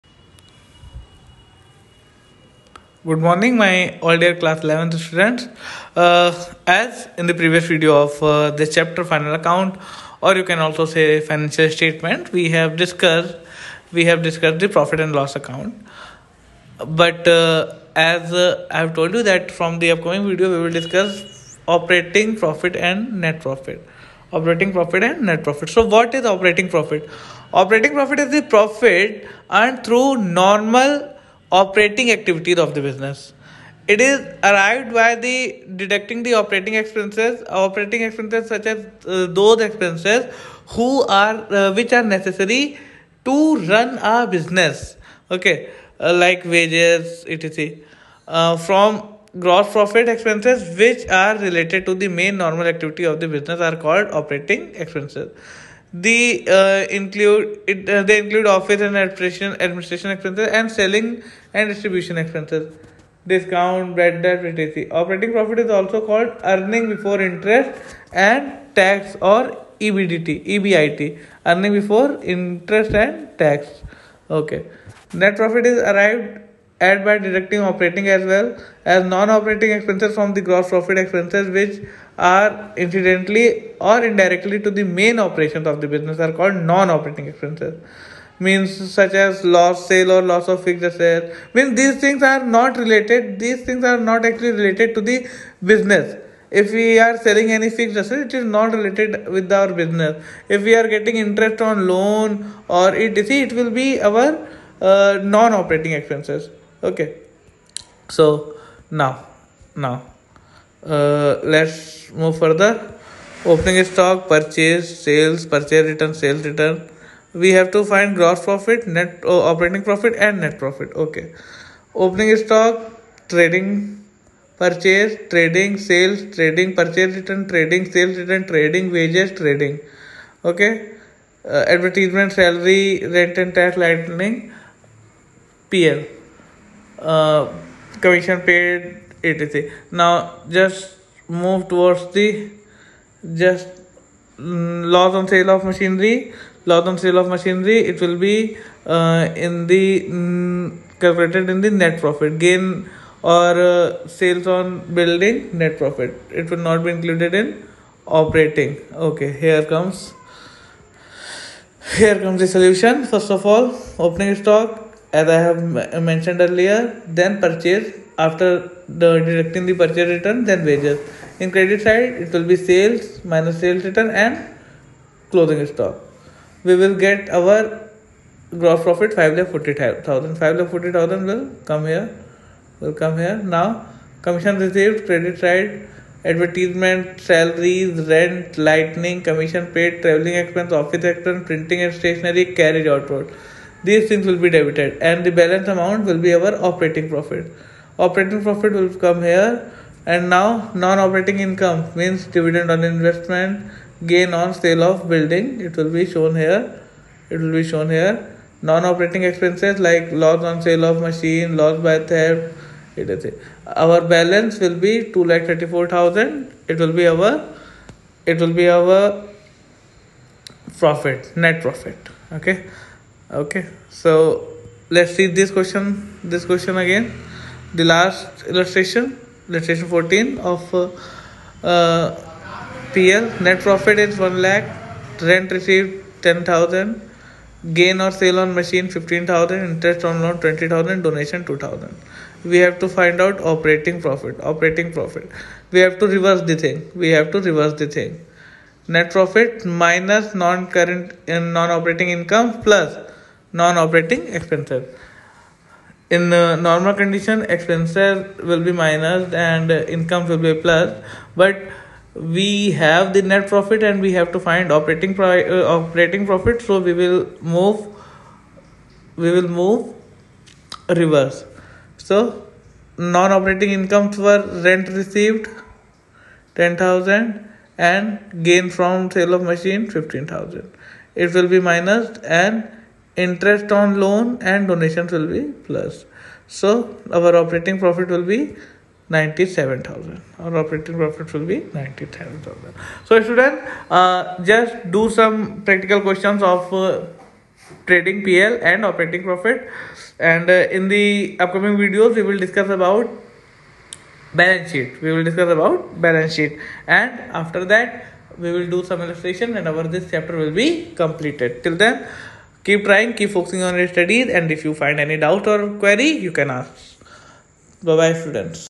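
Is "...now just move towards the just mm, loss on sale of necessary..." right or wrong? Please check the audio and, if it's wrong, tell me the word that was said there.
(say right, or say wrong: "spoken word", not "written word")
wrong: "machinery", not "necessary".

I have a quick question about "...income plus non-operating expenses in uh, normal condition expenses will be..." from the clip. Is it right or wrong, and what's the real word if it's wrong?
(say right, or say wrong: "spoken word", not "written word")
right.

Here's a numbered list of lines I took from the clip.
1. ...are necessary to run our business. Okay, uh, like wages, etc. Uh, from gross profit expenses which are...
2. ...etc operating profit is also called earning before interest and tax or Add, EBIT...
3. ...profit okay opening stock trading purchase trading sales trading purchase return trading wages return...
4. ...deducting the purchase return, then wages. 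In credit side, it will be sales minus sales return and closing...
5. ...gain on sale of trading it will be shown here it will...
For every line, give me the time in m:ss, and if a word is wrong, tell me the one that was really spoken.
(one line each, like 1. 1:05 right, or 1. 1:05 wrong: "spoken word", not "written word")
1. 0:41 right
2. 1:04 wrong: "EBDT", not "Add"
3. 2:00 wrong: "sales", not "wages"
4. 2:49 right
5. 3:24 wrong: "building", not "trading".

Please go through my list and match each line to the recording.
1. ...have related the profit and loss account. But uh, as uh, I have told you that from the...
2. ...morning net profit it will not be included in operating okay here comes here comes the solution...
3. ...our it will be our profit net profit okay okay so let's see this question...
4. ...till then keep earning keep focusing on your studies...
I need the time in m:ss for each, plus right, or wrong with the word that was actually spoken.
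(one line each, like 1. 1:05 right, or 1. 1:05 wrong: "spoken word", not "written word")
1. 0:14 wrong: "discussed", not "related"
2. 2:34 wrong: "building", not "morning"
3. 3:37 right
4. 5:11 wrong: "trying", not "earning".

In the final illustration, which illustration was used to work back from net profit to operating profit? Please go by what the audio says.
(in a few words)
Illustration 14.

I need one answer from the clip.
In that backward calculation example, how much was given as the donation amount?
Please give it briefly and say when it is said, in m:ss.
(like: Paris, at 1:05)
2,000, at 4:01.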